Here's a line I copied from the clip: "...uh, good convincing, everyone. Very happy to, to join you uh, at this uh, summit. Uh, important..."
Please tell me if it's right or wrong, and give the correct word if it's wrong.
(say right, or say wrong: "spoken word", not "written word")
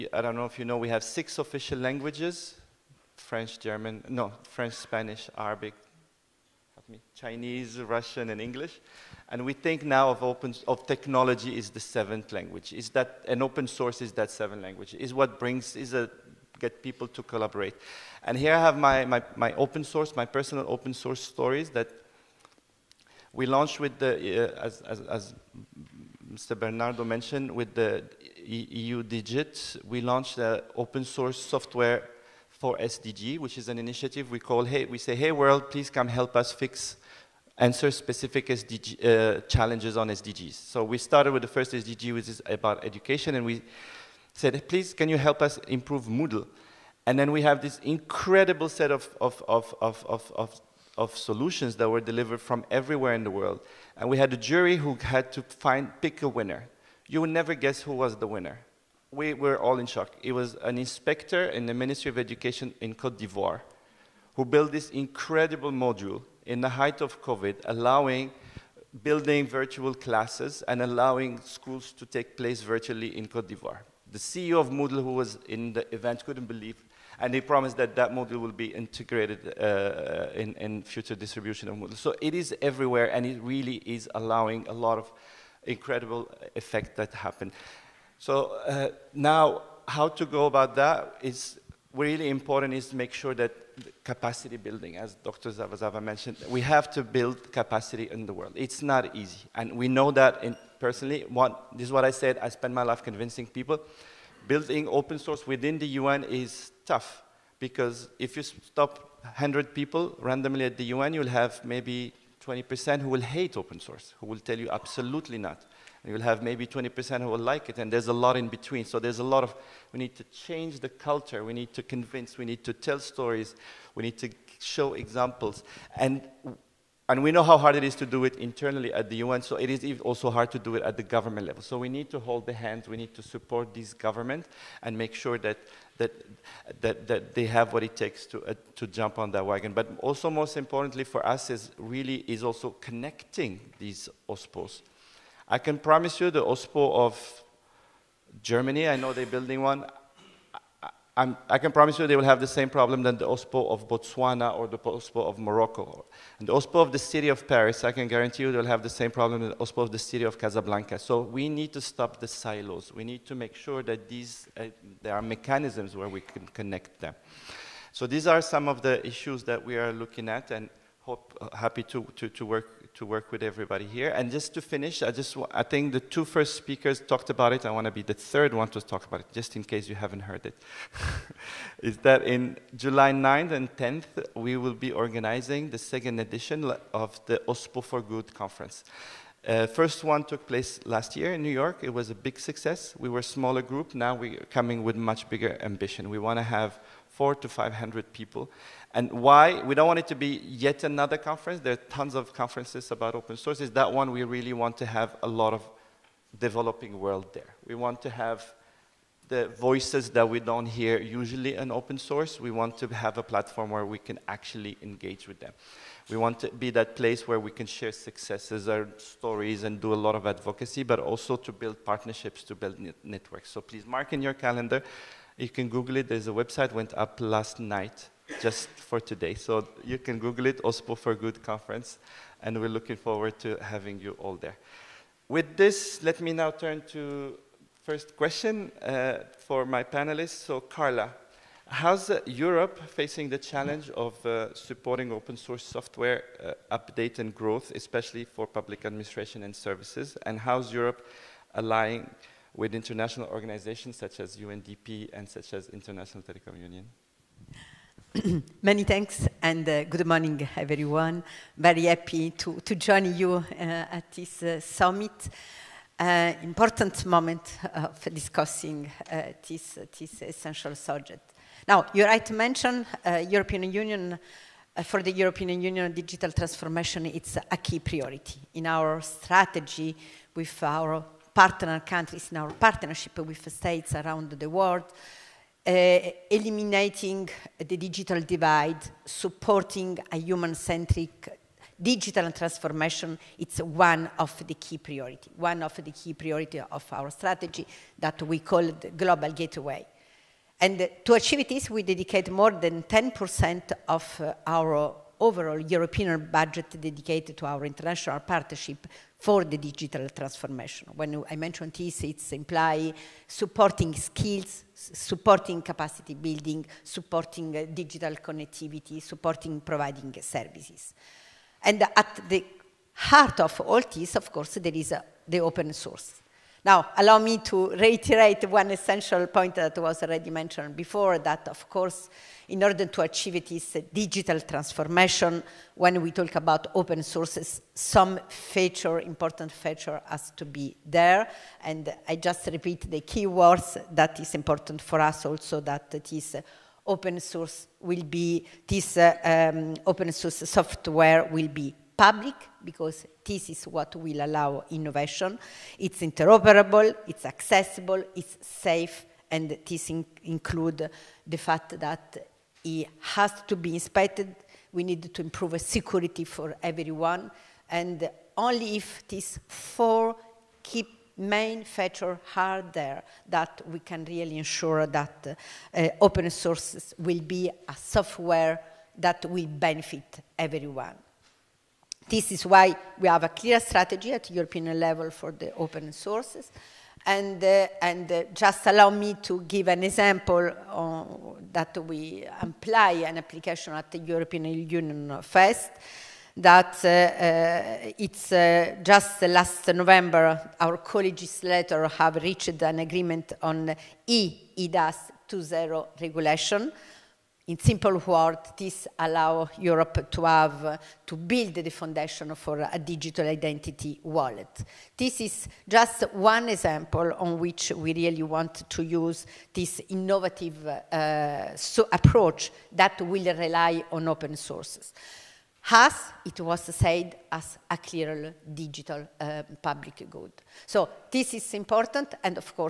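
wrong: "morning", not "convincing".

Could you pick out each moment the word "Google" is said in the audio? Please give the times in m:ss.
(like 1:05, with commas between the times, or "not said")
3:45, 3:50.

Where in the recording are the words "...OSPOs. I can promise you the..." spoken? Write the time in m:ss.
2:24.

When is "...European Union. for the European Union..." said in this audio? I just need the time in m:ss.
4:33.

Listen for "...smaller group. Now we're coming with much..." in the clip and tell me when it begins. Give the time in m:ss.
3:13.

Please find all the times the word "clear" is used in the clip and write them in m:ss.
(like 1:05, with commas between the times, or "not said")
6:23, 7:07.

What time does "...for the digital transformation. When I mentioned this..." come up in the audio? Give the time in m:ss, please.
5:09.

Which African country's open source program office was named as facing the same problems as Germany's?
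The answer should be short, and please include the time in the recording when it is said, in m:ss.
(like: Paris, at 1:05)
Botswana, at 2:33.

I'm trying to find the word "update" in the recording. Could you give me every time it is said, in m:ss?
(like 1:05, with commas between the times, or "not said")
4:06.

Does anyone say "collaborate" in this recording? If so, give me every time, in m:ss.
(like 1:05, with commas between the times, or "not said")
0:17.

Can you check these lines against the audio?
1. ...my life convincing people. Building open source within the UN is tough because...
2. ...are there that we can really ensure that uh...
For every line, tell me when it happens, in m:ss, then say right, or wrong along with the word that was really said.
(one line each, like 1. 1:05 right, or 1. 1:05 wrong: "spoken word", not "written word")
1. 1:42 right
2. 6:12 right.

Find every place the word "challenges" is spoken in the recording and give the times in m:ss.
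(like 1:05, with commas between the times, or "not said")
0:39, 4:03.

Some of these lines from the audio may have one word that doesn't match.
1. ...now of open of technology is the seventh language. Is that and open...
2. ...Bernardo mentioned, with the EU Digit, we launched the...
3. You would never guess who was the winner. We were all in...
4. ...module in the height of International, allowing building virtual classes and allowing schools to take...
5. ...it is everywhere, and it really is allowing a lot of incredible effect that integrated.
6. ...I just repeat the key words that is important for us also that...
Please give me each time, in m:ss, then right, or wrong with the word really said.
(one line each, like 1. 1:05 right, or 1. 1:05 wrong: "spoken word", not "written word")
1. 0:09 right
2. 0:26 right
3. 0:57 right
4. 1:05 wrong: "COVID", not "International"
5. 1:22 wrong: "happened", not "integrated"
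6. 5:42 right.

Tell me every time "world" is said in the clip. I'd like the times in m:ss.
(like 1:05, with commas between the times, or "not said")
0:35, 0:53, 1:38, 3:26, 4:44.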